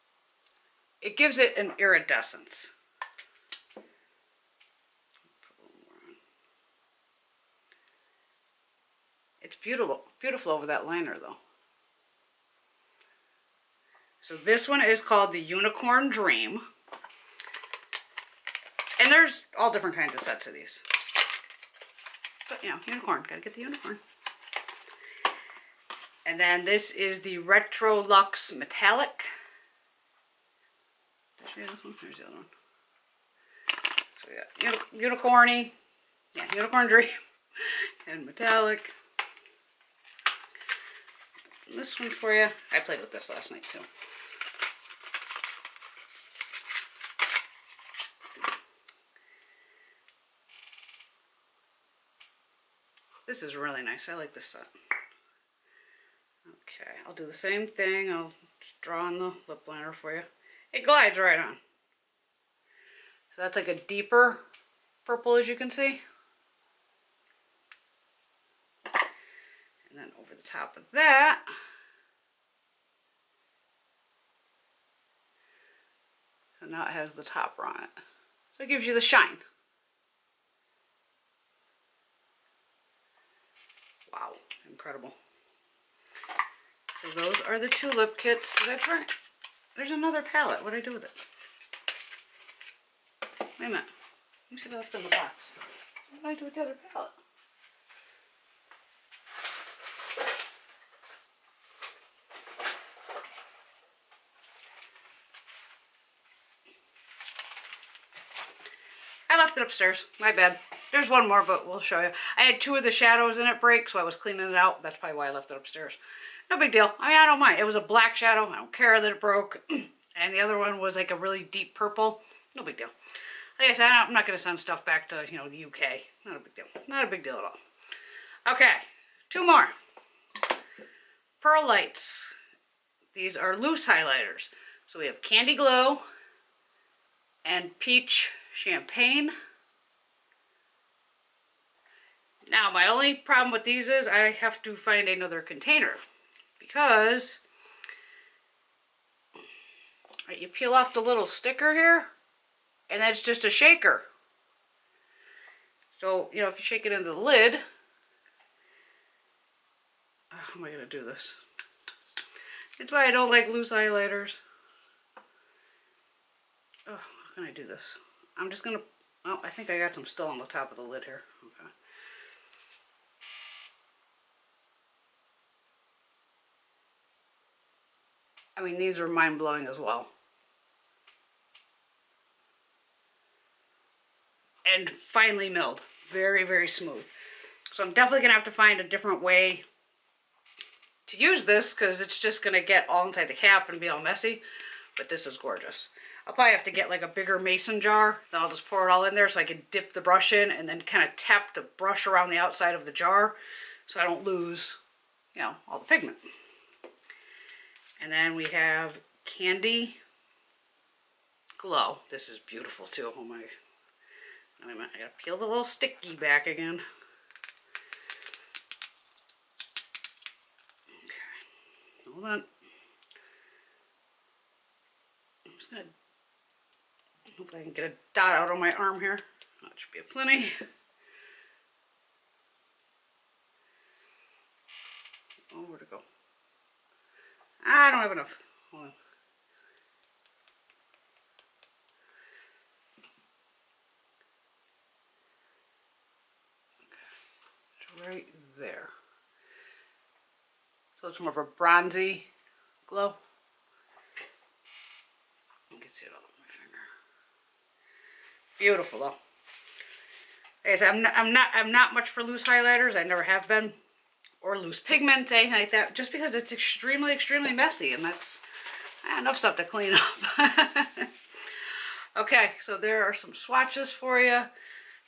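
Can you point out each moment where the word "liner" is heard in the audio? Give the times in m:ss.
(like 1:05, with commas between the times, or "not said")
0:10, 0:59.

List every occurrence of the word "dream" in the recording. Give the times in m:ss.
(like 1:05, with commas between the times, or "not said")
0:16, 0:36.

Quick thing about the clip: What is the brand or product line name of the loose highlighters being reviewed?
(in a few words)
Pearl Lights.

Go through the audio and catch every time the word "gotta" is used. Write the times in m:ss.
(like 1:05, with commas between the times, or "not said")
0:23, 3:34.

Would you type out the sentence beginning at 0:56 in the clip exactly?
Okay, I'll do the same thing.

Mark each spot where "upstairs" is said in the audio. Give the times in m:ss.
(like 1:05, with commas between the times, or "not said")
1:49, 1:55.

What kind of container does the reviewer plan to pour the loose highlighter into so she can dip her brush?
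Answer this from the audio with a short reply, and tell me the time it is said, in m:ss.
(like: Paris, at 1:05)
mason jar, at 3:17.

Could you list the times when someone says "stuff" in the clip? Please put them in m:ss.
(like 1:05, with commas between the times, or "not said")
2:04, 4:29.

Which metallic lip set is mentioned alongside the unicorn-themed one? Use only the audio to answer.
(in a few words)
Retro Luxe Metallic.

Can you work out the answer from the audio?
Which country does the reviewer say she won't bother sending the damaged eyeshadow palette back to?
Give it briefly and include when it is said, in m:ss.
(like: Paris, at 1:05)
the UK, at 2:05.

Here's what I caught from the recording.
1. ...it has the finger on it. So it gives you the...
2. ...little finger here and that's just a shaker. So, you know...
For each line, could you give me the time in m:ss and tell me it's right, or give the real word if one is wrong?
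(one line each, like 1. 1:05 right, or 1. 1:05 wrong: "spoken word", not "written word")
1. 1:16 wrong: "topper", not "finger"
2. 2:30 wrong: "sticker", not "finger".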